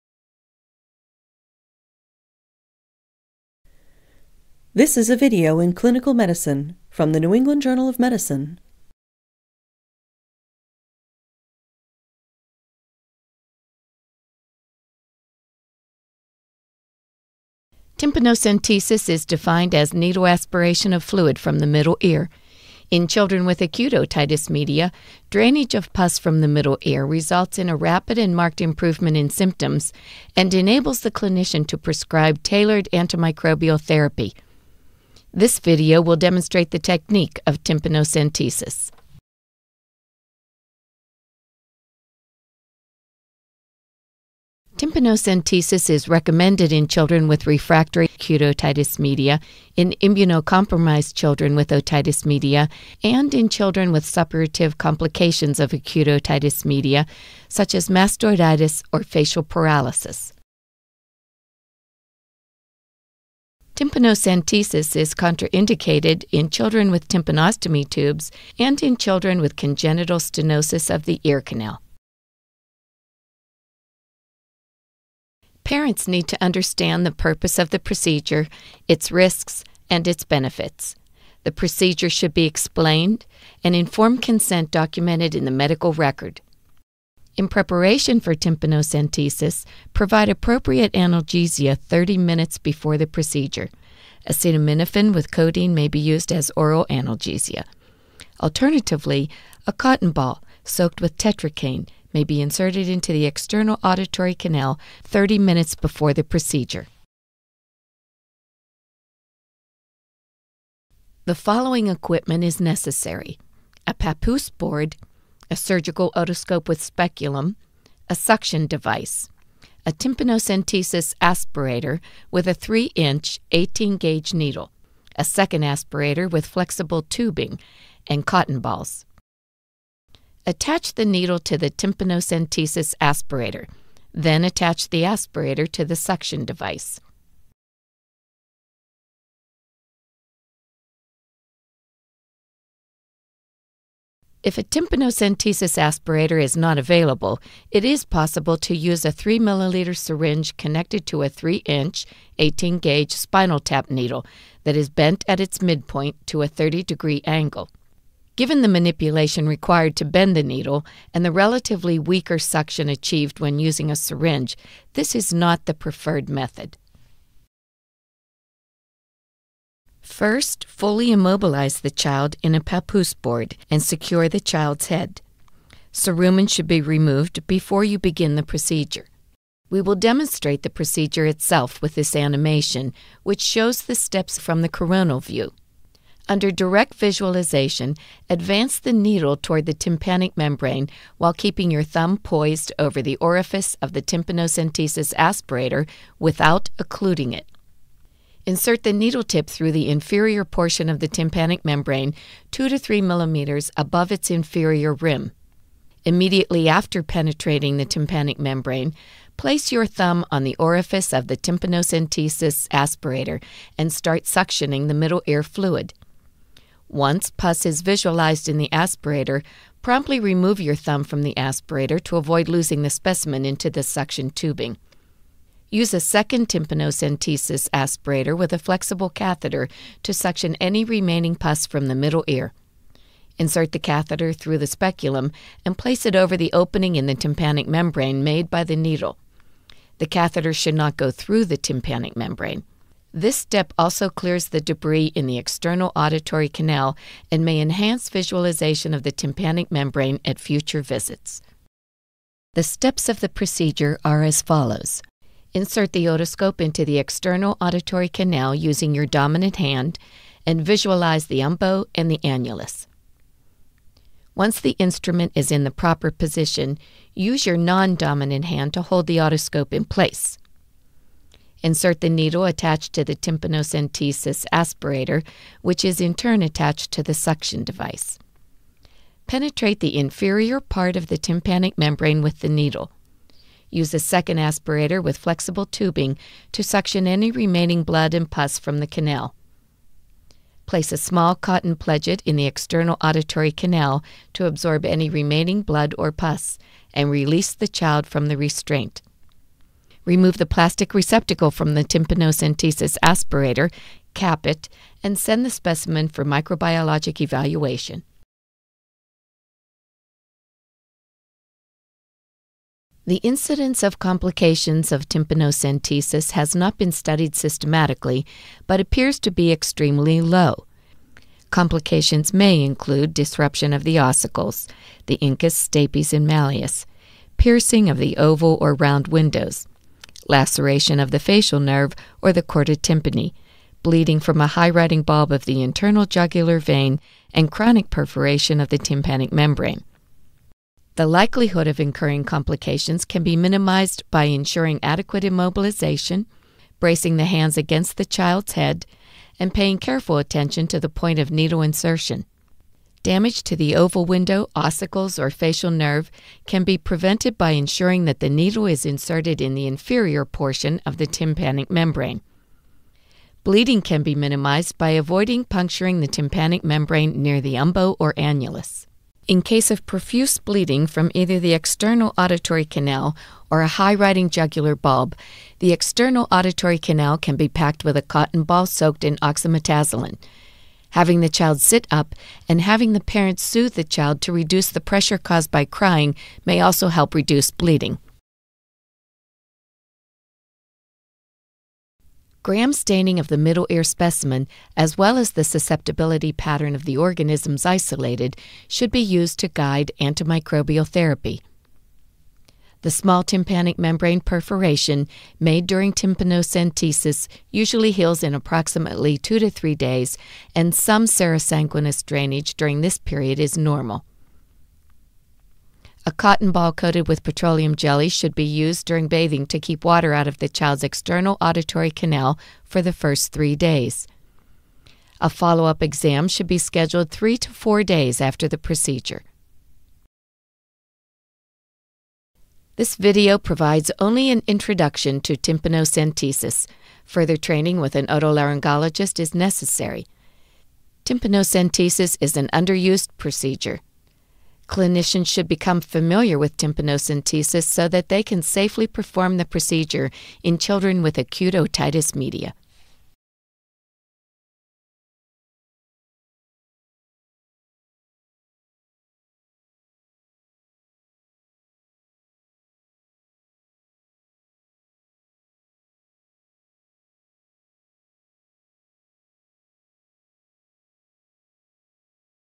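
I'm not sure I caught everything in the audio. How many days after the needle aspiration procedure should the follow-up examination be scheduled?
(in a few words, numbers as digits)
3 to 4 days.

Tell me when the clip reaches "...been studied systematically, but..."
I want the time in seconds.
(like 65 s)
316 s.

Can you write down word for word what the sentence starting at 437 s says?
Further training with an otolaryngologist is necessary.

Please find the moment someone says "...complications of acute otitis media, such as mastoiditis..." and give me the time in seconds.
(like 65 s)
54 s.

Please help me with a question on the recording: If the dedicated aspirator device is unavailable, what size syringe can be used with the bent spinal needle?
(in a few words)
3 milliliter.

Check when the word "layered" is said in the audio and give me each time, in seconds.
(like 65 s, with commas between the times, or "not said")
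not said.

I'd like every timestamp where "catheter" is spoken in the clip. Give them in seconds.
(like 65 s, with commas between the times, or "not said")
229 s, 233 s, 240 s.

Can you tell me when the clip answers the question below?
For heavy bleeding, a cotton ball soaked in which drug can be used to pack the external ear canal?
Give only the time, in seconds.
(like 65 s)
379 s.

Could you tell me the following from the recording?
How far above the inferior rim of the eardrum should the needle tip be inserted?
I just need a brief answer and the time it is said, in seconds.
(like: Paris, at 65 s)
2 to 3 millimeters, at 202 s.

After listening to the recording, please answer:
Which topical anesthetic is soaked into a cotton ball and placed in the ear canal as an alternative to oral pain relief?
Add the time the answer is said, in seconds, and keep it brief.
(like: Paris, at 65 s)
tetracaine, at 101 s.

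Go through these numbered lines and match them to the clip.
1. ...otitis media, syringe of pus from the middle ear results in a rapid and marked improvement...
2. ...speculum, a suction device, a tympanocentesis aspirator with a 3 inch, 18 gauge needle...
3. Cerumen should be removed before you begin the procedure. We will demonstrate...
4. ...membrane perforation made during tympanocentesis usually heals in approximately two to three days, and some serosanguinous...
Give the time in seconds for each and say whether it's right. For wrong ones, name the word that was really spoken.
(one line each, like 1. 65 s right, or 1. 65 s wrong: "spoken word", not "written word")
1. 23 s wrong: "drainage", not "syringe"
2. 116 s right
3. 175 s right
4. 403 s right.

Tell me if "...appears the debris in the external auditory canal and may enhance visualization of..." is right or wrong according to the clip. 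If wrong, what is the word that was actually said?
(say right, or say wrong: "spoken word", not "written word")
wrong: "clears", not "appears".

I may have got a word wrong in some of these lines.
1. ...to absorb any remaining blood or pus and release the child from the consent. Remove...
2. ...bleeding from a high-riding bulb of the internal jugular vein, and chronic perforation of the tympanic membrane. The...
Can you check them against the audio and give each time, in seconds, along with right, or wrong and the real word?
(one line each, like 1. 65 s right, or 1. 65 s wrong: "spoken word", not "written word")
1. 294 s wrong: "restraint", not "consent"
2. 333 s right.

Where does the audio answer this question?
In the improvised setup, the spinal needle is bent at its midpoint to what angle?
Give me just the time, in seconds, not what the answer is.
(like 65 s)
156 s.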